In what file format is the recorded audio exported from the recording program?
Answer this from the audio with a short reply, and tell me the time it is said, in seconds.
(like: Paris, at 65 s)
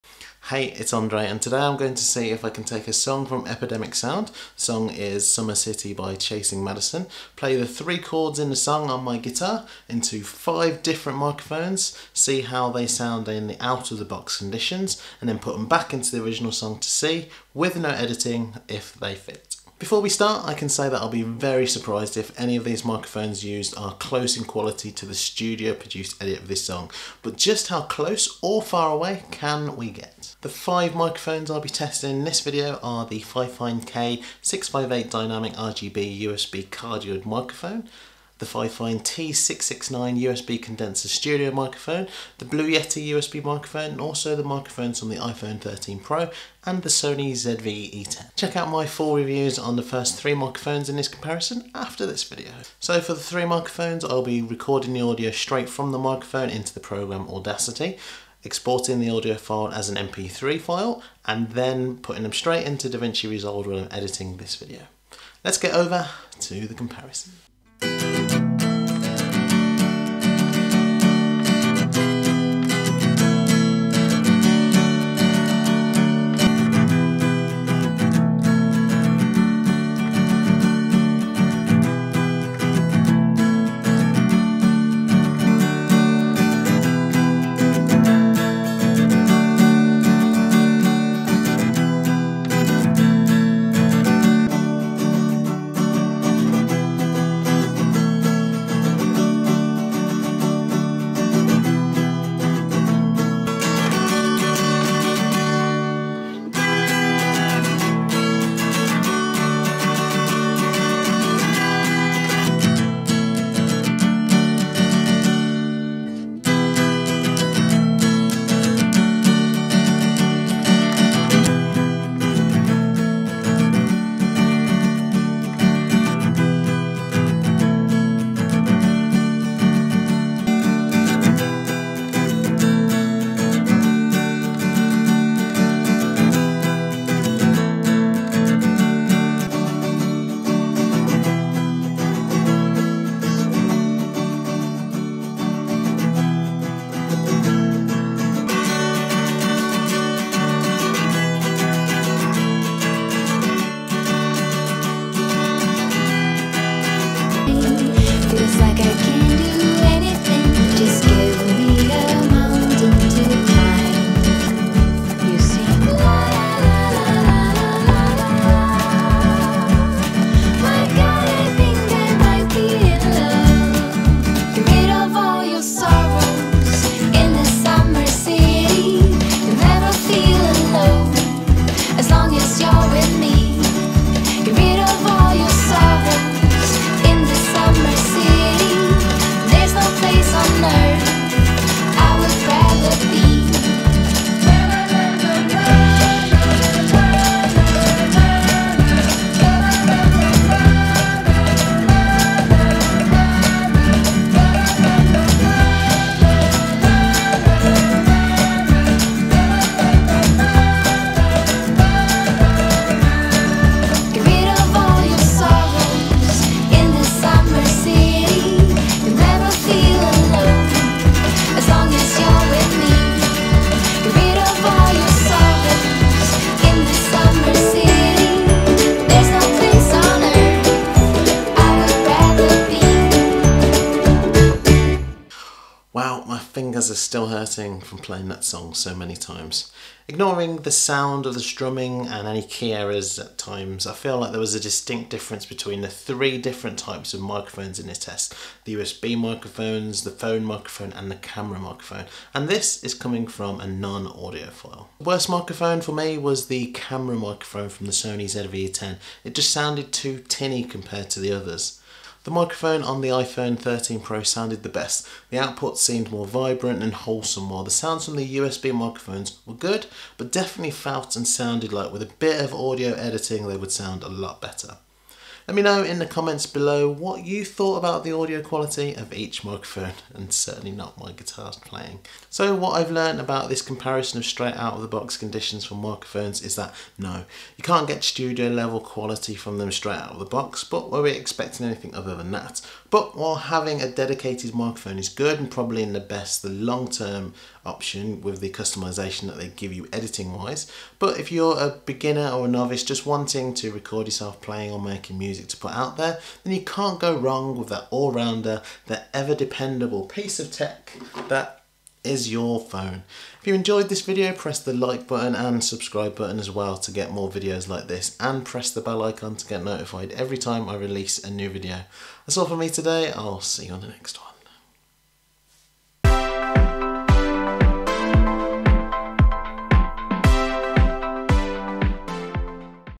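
MP3, at 59 s.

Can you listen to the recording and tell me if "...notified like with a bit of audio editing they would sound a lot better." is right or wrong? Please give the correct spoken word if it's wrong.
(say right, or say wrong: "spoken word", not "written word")
wrong: "sounded", not "notified".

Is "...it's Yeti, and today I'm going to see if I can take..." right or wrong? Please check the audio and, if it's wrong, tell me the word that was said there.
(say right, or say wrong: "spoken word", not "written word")
wrong: "Andre", not "Yeti".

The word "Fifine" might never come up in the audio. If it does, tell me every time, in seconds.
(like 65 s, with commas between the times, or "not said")
33 s, 38 s.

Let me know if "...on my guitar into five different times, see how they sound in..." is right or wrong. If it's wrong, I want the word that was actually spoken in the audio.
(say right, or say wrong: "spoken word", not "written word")
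wrong: "microphones", not "times".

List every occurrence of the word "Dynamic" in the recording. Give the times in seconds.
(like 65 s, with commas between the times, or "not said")
35 s.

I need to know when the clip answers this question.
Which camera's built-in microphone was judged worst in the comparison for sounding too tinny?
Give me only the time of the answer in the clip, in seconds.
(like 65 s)
257 s.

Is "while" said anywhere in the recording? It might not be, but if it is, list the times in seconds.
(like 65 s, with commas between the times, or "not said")
267 s, 293 s.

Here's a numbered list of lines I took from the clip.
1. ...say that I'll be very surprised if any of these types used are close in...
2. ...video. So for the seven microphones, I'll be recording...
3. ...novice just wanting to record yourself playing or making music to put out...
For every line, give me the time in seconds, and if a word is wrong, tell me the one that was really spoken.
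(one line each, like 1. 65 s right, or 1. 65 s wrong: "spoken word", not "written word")
1. 20 s wrong: "microphones", not "types"
2. 52 s wrong: "three", not "seven"
3. 302 s right.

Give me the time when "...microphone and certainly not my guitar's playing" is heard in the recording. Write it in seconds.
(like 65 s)
279 s.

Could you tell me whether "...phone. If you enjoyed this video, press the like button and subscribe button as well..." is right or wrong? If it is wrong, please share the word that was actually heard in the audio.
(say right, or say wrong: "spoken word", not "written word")
right.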